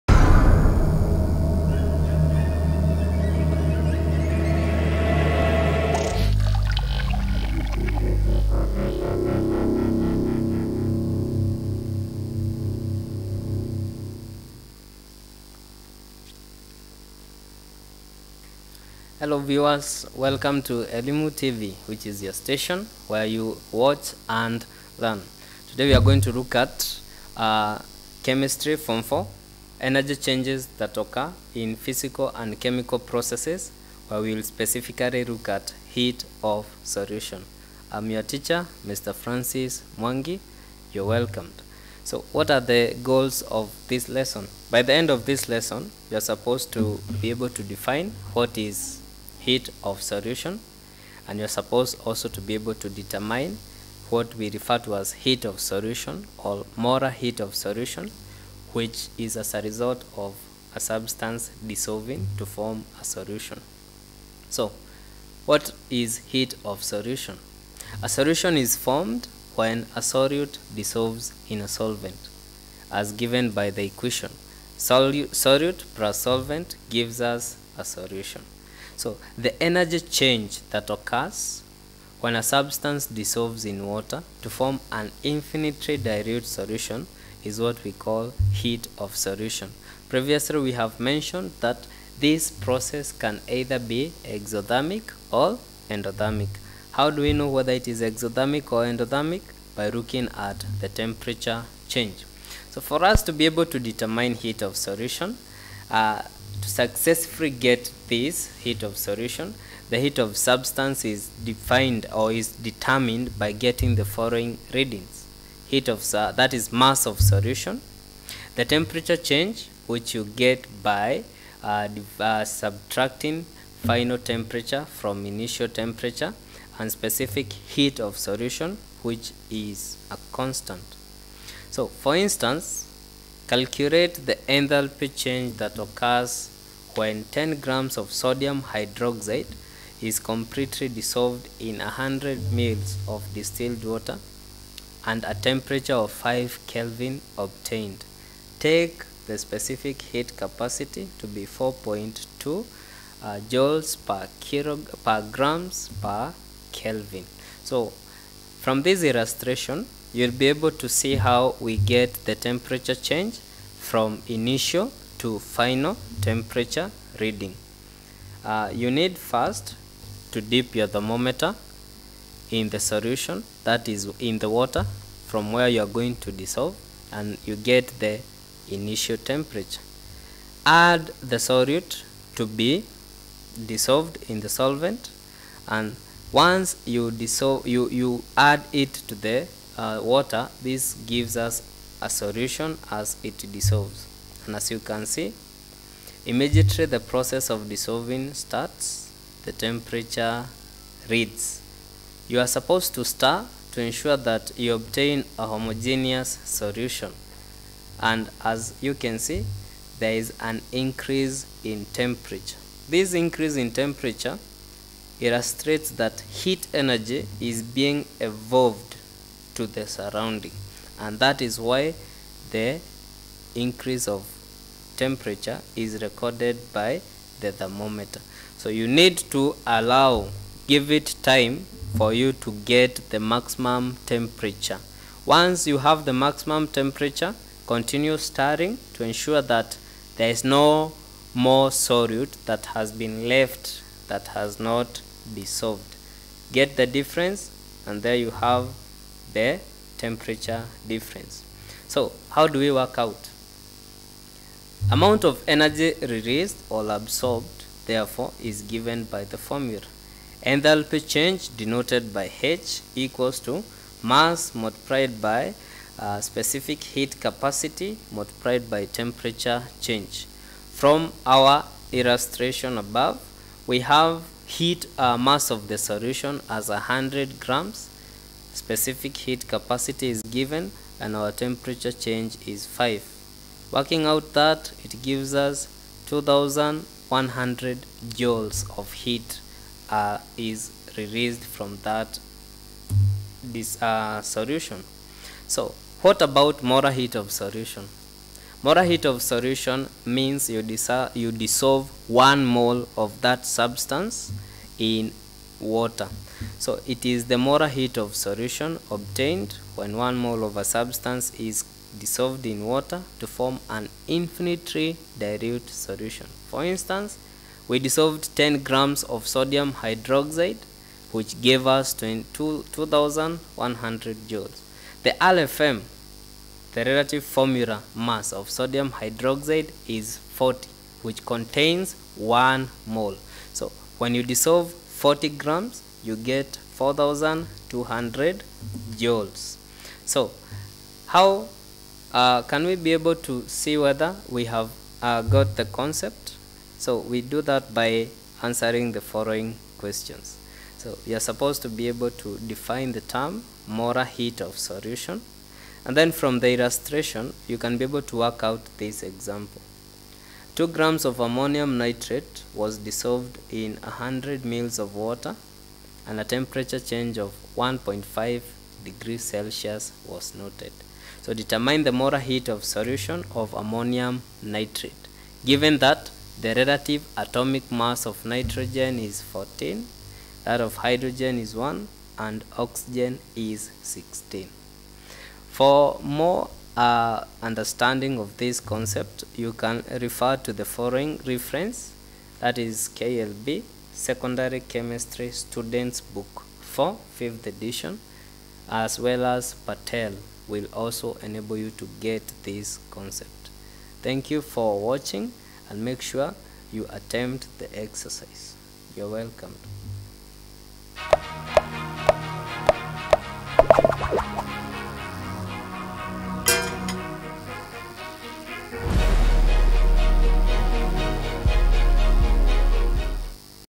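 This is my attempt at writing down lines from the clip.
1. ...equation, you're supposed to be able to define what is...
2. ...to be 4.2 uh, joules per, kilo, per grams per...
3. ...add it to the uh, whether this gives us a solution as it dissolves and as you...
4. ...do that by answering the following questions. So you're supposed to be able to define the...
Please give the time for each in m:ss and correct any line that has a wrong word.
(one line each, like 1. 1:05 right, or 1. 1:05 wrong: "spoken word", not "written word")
1. 0:45 wrong: "lesson", not "equation"
2. 2:31 right
3. 3:08 wrong: "water", not "whether"
4. 5:47 right.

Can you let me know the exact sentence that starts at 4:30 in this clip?
From our illustration above, we have heat uh, mass of the solution as 100 grams.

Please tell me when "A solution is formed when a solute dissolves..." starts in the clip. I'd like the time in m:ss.
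1:08.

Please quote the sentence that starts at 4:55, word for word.
So what about molar heat of solution?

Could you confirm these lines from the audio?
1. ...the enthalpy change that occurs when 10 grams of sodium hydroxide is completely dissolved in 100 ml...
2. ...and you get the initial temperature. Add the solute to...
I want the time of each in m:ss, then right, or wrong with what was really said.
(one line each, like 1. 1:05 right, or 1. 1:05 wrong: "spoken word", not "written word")
1. 2:14 right
2. 2:57 right.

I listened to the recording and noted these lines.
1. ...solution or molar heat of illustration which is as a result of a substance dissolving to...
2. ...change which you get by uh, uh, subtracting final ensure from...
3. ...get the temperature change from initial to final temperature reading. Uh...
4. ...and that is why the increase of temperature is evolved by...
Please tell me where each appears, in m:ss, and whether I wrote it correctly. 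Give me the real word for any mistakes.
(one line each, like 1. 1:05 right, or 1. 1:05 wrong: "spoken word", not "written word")
1. 0:55 wrong: "solution", not "illustration"
2. 1:59 wrong: "temperature", not "ensure"
3. 2:41 right
4. 3:40 wrong: "recorded", not "evolved".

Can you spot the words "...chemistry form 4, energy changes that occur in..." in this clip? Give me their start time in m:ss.
0:28.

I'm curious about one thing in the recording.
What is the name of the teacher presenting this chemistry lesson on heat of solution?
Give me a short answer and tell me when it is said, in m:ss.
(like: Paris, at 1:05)
Francis Mwangi, at 0:38.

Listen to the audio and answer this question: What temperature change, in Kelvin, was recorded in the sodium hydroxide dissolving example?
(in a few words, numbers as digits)
5.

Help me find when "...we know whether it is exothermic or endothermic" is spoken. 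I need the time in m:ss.
1:37.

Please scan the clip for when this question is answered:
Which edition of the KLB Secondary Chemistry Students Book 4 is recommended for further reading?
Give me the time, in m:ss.
6:37.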